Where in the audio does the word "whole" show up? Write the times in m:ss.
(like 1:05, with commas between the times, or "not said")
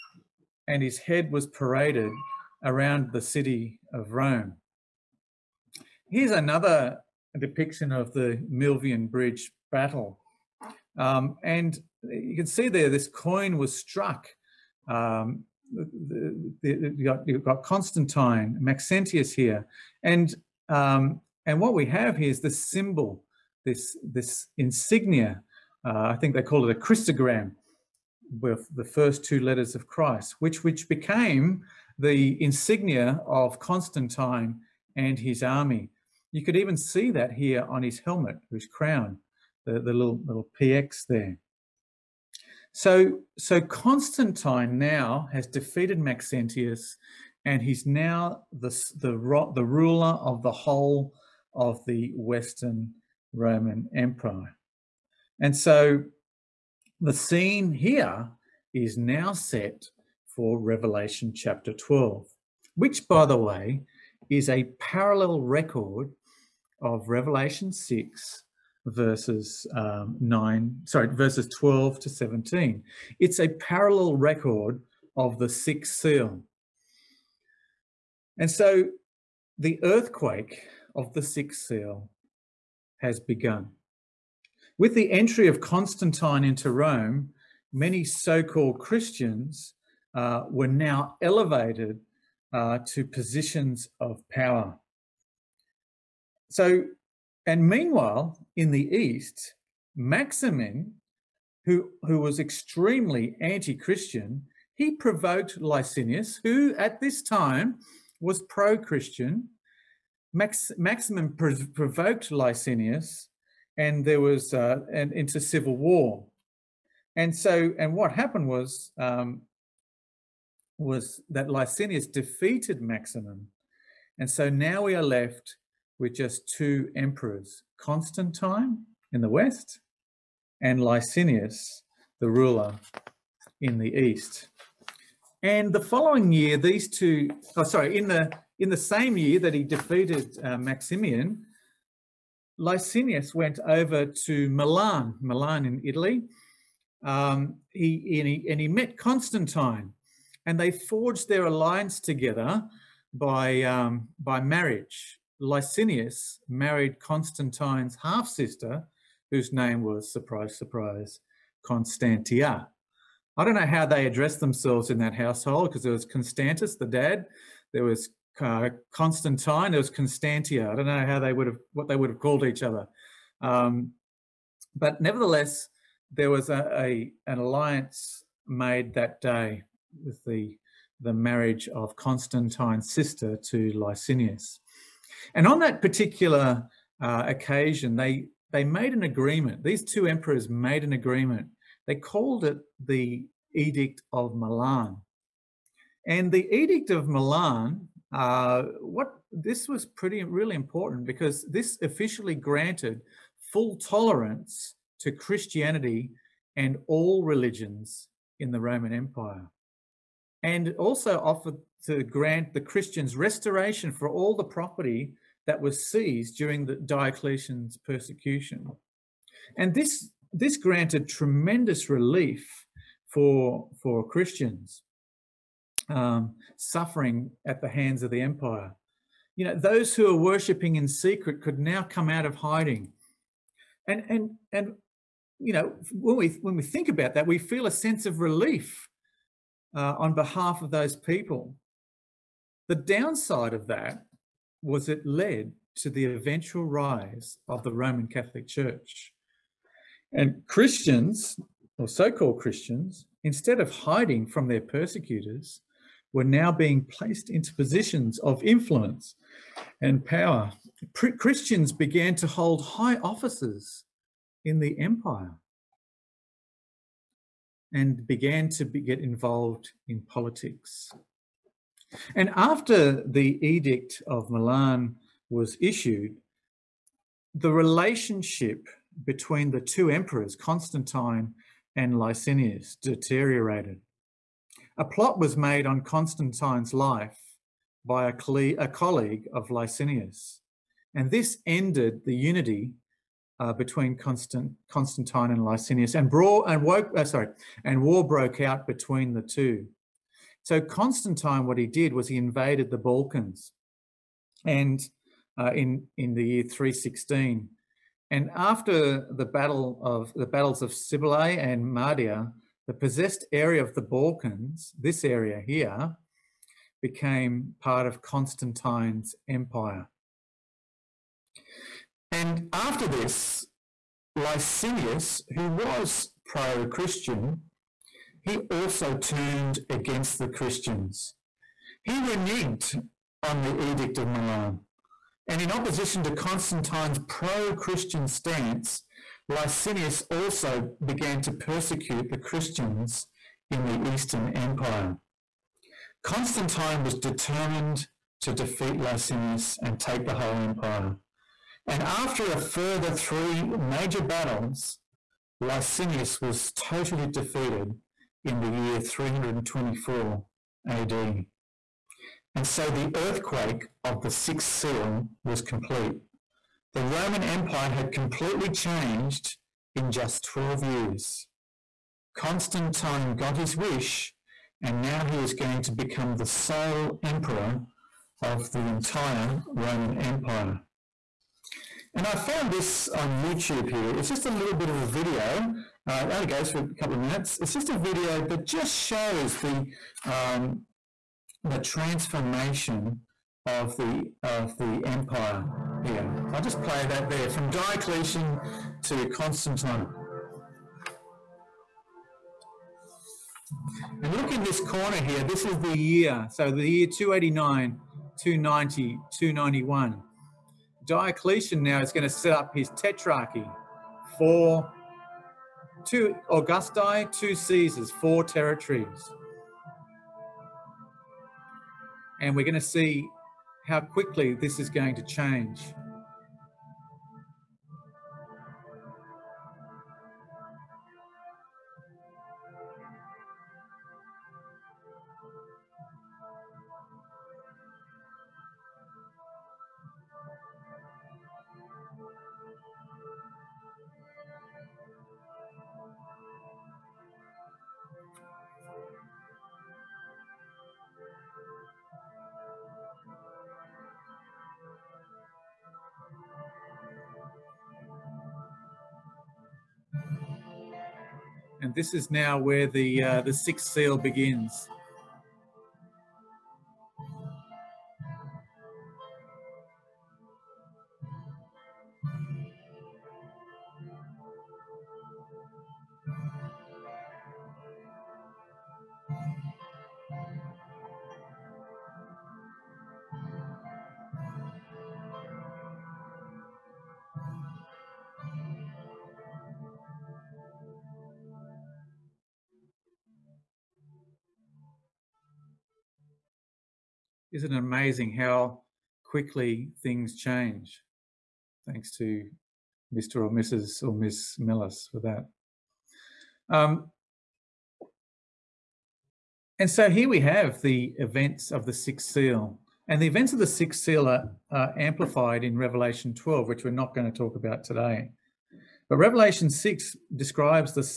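0:50, 5:50.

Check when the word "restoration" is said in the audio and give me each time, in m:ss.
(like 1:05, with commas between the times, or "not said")
3:33.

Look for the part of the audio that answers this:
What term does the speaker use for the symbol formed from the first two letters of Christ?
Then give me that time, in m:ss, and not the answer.
0:26.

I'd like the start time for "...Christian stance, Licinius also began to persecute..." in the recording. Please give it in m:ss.
5:37.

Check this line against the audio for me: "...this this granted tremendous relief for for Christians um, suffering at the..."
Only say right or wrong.
right.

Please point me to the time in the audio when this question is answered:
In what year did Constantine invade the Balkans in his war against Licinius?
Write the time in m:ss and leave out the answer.
5:06.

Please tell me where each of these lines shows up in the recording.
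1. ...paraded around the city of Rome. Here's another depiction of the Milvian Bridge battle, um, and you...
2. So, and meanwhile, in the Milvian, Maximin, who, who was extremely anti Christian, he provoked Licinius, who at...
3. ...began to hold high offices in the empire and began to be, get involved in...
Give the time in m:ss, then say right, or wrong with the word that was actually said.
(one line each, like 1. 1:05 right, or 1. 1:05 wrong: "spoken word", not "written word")
1. 0:01 right
2. 1:36 wrong: "East", not "Milvian"
3. 4:21 right.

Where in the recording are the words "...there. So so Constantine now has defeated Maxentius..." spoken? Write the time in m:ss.
0:41.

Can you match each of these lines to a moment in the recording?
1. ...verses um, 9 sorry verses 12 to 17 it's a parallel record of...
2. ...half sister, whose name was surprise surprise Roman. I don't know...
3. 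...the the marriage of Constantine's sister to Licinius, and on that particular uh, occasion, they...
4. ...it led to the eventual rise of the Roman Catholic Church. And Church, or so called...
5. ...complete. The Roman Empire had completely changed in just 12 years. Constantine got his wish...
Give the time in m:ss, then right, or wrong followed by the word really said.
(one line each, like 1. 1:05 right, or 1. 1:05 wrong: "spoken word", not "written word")
1. 1:08 right
2. 2:38 wrong: "Constantia", not "Roman"
3. 3:00 right
4. 4:04 wrong: "Christians", not "Church"
5. 6:05 right.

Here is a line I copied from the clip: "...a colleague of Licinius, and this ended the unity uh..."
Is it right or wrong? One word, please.
right.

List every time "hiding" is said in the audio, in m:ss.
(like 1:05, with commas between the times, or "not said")
3:52, 4:13.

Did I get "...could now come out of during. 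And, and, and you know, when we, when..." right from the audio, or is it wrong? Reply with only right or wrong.
wrong.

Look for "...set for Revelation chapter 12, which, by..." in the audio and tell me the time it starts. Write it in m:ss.
0:59.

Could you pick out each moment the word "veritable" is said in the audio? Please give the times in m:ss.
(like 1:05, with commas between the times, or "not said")
not said.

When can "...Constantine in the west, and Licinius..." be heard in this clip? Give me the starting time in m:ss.
2:07.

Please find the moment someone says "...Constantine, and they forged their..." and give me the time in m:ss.
2:28.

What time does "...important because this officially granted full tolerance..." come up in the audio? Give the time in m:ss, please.
3:20.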